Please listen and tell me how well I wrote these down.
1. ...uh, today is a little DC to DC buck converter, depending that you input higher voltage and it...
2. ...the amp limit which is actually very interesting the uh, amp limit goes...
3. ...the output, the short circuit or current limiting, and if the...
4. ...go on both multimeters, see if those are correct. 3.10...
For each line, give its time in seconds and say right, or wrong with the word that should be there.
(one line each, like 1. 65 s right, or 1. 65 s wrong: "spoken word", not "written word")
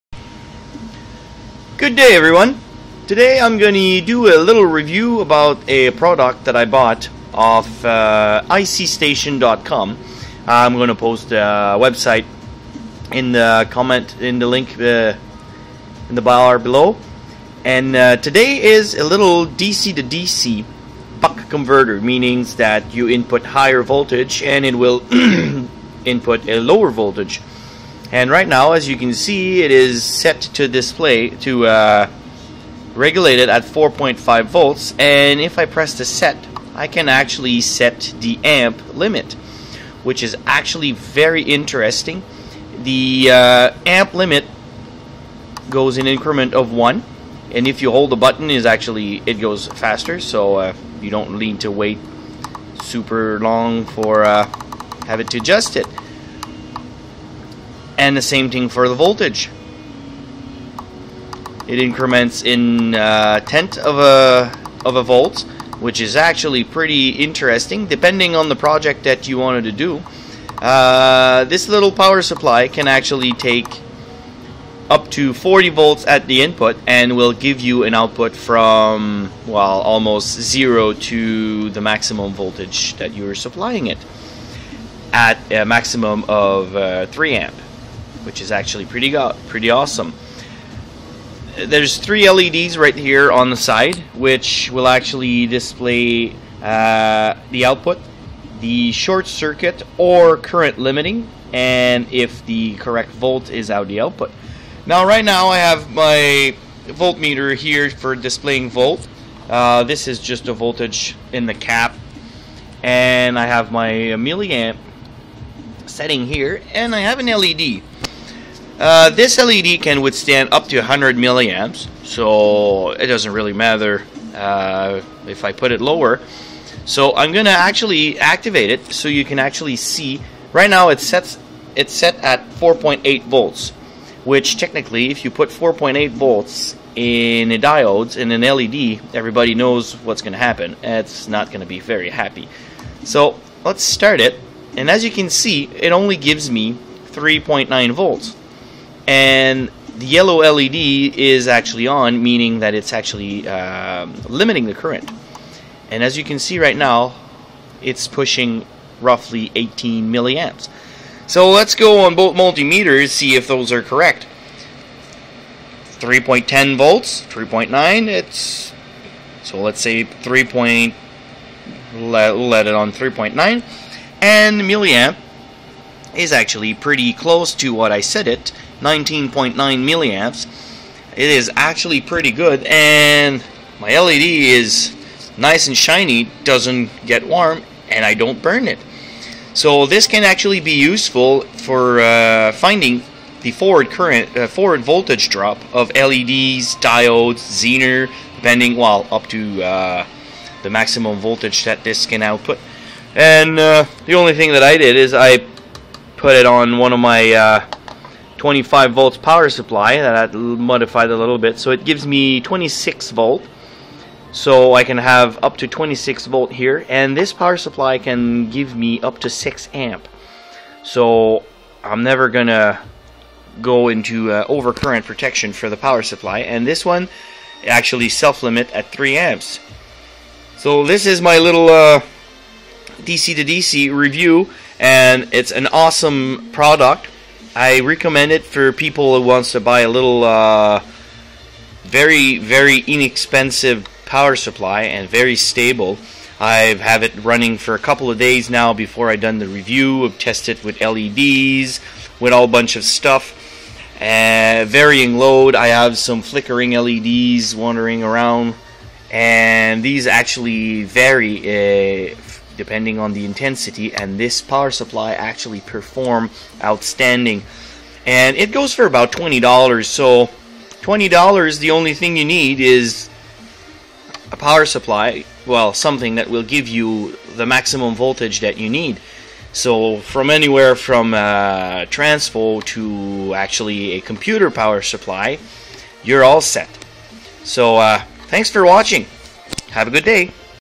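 1. 17 s wrong: "meaning", not "depending"
2. 38 s right
3. 97 s right
4. 161 s right.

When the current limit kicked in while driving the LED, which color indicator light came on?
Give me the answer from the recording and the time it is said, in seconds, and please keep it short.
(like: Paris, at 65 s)
Yellow, at 150 s.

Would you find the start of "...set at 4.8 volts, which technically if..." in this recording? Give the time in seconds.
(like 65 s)
131 s.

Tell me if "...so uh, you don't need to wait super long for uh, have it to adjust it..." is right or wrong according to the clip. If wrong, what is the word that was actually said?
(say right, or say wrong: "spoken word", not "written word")
right.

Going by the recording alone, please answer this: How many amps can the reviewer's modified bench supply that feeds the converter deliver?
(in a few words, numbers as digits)
6 amps.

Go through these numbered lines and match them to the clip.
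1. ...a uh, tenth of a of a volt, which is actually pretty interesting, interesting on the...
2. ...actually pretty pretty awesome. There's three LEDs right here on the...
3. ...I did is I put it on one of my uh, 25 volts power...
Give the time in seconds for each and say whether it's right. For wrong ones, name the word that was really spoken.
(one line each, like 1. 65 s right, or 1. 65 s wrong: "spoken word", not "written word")
1. 62 s wrong: "depending", not "interesting"
2. 88 s right
3. 204 s right.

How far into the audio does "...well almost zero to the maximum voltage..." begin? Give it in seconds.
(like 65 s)
79 s.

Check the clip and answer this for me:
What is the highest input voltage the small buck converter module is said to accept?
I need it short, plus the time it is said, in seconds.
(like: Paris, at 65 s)
40 volts, at 75 s.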